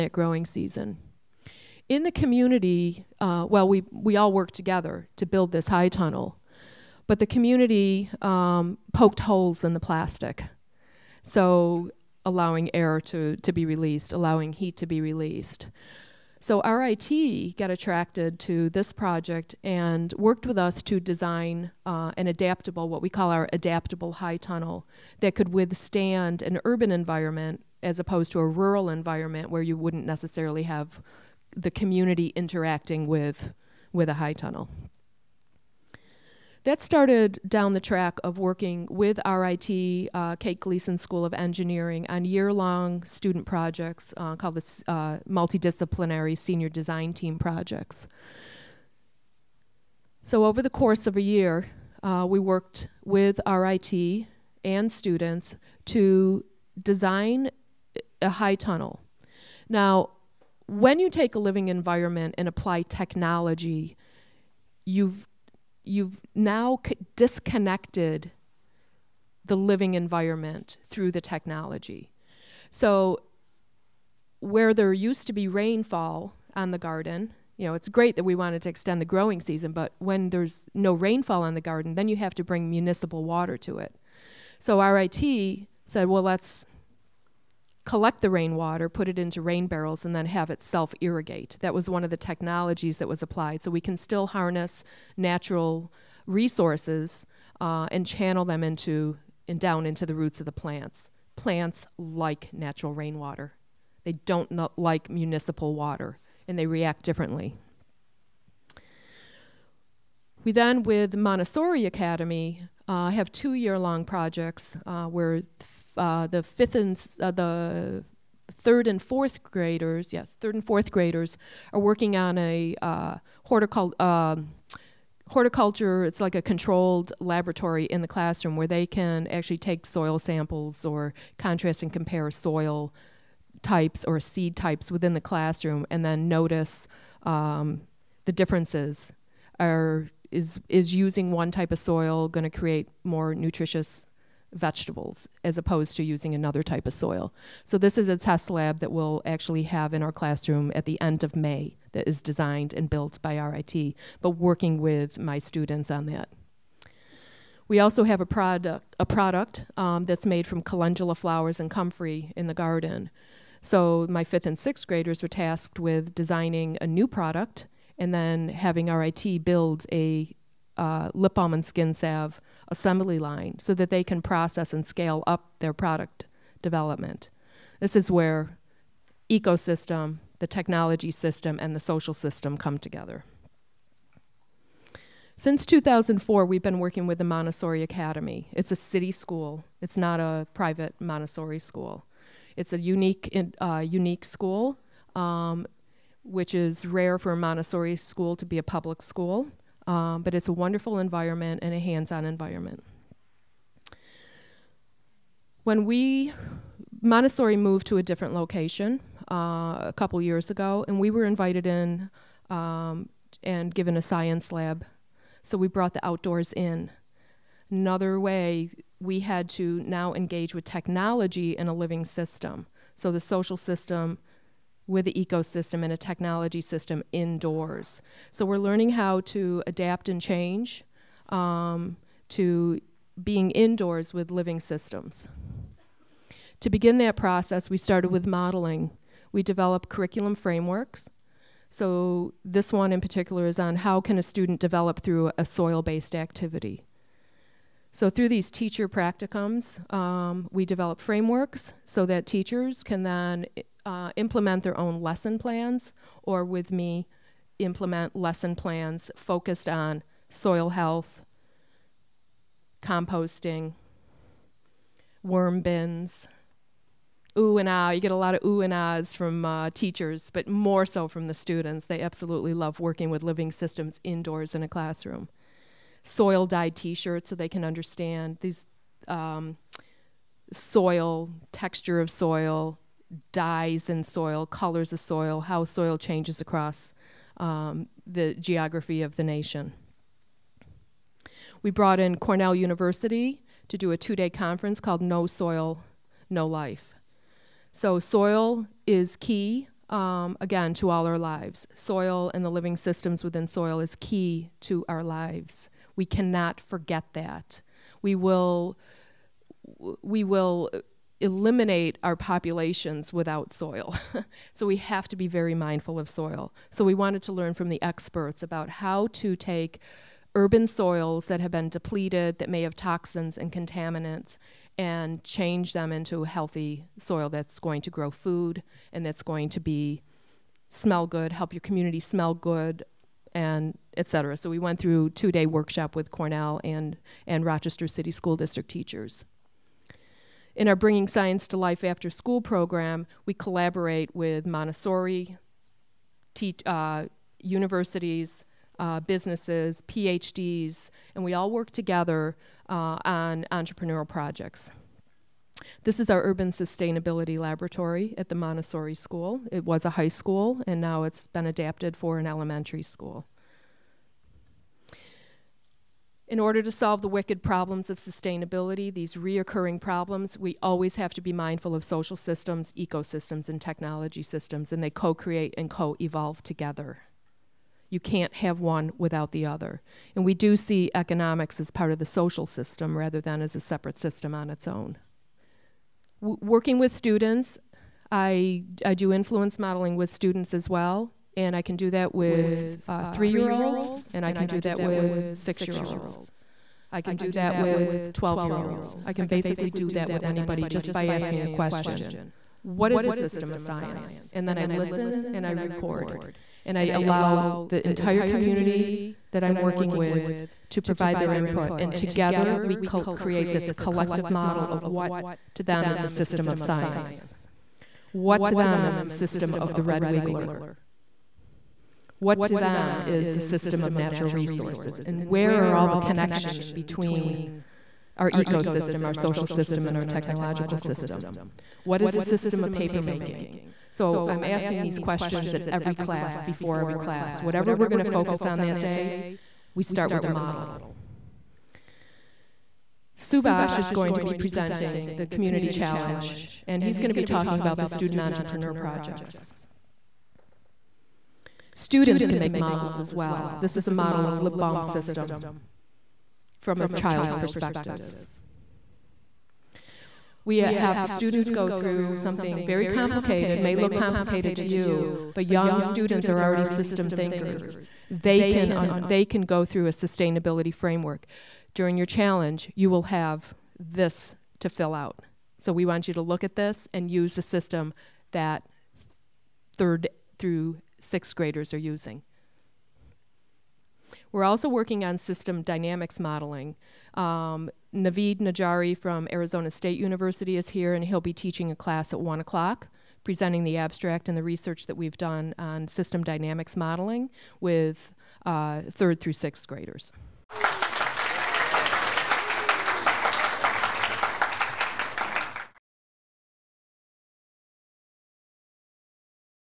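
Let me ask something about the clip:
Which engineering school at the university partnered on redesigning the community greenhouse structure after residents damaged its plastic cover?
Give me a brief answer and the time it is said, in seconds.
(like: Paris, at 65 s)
Kate Gleason School of Engineering, at 40 s.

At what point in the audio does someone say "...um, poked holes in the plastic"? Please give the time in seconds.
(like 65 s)
8 s.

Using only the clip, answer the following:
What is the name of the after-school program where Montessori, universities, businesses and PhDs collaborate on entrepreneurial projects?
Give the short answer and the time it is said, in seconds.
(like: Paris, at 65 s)
Bringing Science to Life, at 340 s.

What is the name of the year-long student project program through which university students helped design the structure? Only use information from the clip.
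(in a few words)
Multidisciplinary Senior Design.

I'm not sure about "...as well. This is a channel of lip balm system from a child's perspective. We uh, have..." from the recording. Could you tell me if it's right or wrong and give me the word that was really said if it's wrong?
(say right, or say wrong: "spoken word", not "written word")
wrong: "model", not "channel".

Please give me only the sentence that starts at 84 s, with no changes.
So RIT said, well, let's collect the rainwater, put it into rain barrels, and then have it self irrigate.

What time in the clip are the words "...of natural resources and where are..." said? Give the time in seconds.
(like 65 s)
423 s.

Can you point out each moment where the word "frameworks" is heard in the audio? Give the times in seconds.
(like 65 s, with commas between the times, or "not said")
240 s, 250 s, 470 s.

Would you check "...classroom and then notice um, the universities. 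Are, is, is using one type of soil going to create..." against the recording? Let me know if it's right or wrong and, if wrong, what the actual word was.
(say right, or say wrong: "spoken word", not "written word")
wrong: "differences", not "universities".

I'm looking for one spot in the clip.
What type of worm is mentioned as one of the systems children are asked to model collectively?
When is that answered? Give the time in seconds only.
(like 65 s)
419 s.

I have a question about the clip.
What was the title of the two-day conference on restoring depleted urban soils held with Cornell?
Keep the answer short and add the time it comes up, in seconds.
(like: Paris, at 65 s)
No Soil, No Life, at 295 s.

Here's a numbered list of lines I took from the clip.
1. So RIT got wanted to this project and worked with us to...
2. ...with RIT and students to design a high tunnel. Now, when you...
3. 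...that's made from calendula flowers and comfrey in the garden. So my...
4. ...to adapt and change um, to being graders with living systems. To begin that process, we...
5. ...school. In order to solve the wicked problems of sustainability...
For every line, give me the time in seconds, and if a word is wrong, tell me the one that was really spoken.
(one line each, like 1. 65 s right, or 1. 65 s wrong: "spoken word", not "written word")
1. 16 s wrong: "attracted", not "wanted"
2. 53 s right
3. 160 s right
4. 229 s wrong: "indoors", not "graders"
5. 362 s right.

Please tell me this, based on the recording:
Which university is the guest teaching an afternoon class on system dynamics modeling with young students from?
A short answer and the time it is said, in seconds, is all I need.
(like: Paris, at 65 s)
Arizona State University, at 489 s.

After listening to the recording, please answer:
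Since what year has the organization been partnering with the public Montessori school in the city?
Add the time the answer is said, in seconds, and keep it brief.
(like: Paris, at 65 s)
2004, at 185 s.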